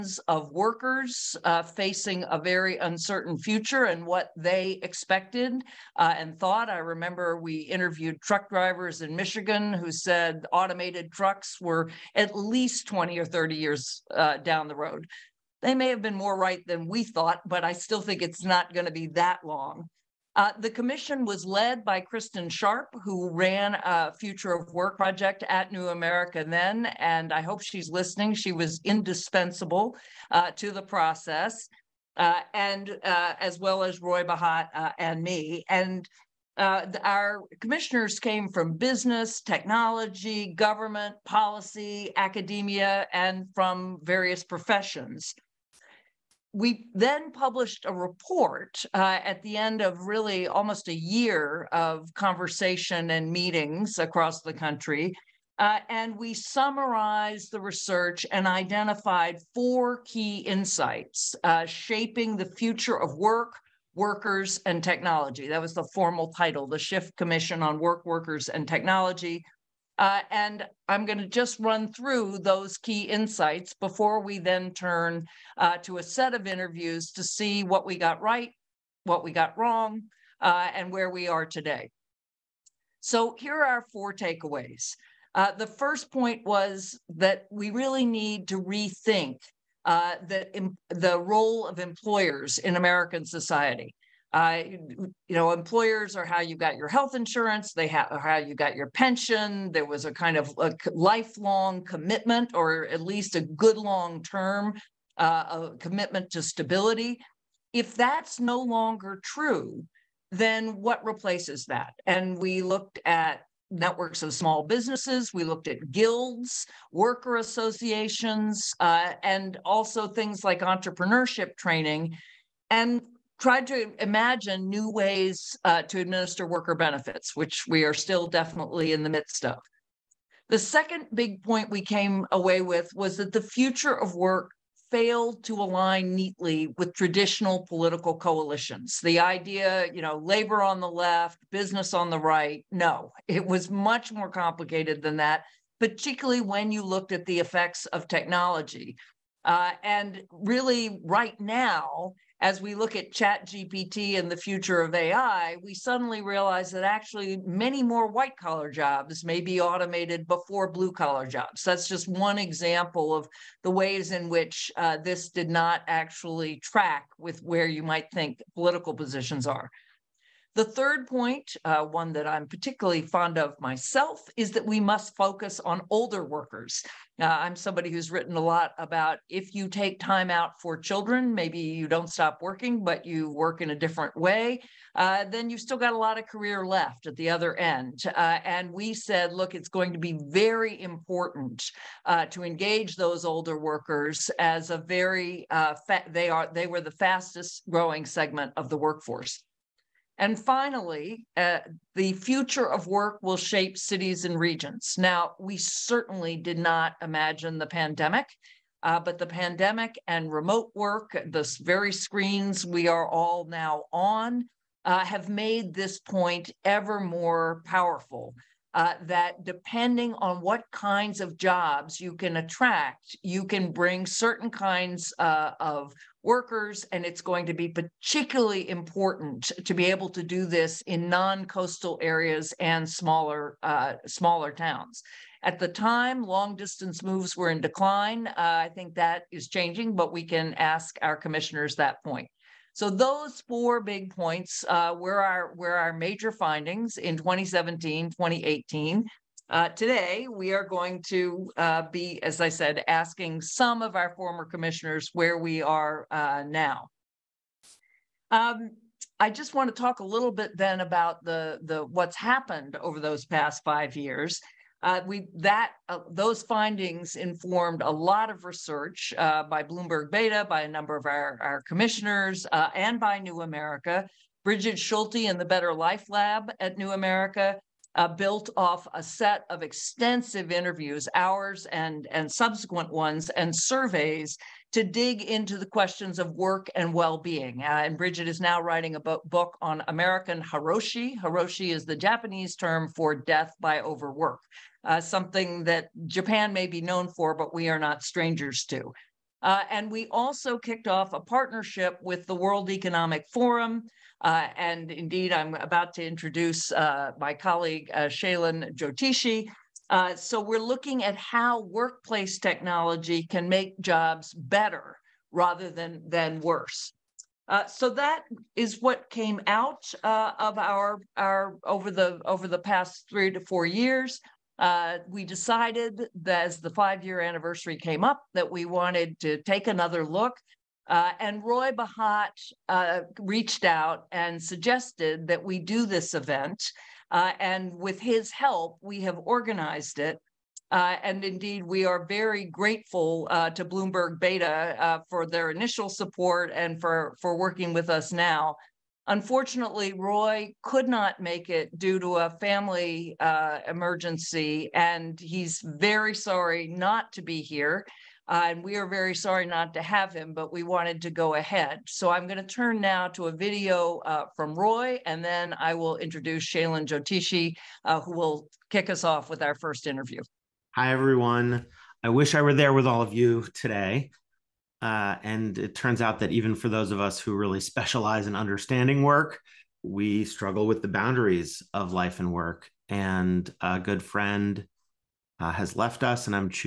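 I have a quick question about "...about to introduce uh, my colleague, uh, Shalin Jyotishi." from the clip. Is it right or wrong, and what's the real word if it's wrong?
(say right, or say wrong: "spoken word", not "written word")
right.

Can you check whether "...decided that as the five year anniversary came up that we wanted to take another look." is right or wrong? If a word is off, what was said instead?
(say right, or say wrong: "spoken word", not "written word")
right.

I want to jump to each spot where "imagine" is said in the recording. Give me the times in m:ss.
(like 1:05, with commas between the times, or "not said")
2:04, 3:27.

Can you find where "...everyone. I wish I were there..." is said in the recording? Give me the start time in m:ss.
6:10.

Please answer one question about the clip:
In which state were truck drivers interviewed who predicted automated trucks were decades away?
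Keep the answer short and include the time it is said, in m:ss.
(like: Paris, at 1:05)
Michigan, at 0:09.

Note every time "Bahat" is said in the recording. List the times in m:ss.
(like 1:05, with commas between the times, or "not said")
0:34, 5:31.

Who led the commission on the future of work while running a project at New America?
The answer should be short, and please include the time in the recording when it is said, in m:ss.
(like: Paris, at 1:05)
Kristin Sharp, at 0:22.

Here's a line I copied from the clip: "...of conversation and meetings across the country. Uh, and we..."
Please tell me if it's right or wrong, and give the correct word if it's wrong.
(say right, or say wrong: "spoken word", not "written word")
right.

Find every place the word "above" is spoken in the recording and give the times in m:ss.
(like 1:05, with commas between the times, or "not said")
not said.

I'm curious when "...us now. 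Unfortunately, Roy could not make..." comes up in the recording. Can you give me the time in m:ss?
5:47.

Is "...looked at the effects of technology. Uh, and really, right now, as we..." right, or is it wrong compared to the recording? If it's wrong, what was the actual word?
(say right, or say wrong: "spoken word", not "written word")
right.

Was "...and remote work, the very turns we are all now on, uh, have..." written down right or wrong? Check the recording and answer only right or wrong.
wrong.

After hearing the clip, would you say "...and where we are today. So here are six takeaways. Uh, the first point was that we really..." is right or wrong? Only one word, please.
wrong.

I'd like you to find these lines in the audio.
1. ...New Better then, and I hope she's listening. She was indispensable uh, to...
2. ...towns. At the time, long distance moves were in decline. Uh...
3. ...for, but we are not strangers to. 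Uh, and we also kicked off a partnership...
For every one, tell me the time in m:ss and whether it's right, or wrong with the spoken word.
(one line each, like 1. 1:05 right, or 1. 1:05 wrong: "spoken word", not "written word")
1. 0:25 wrong: "America", not "Better"
2. 3:54 right
3. 4:57 right.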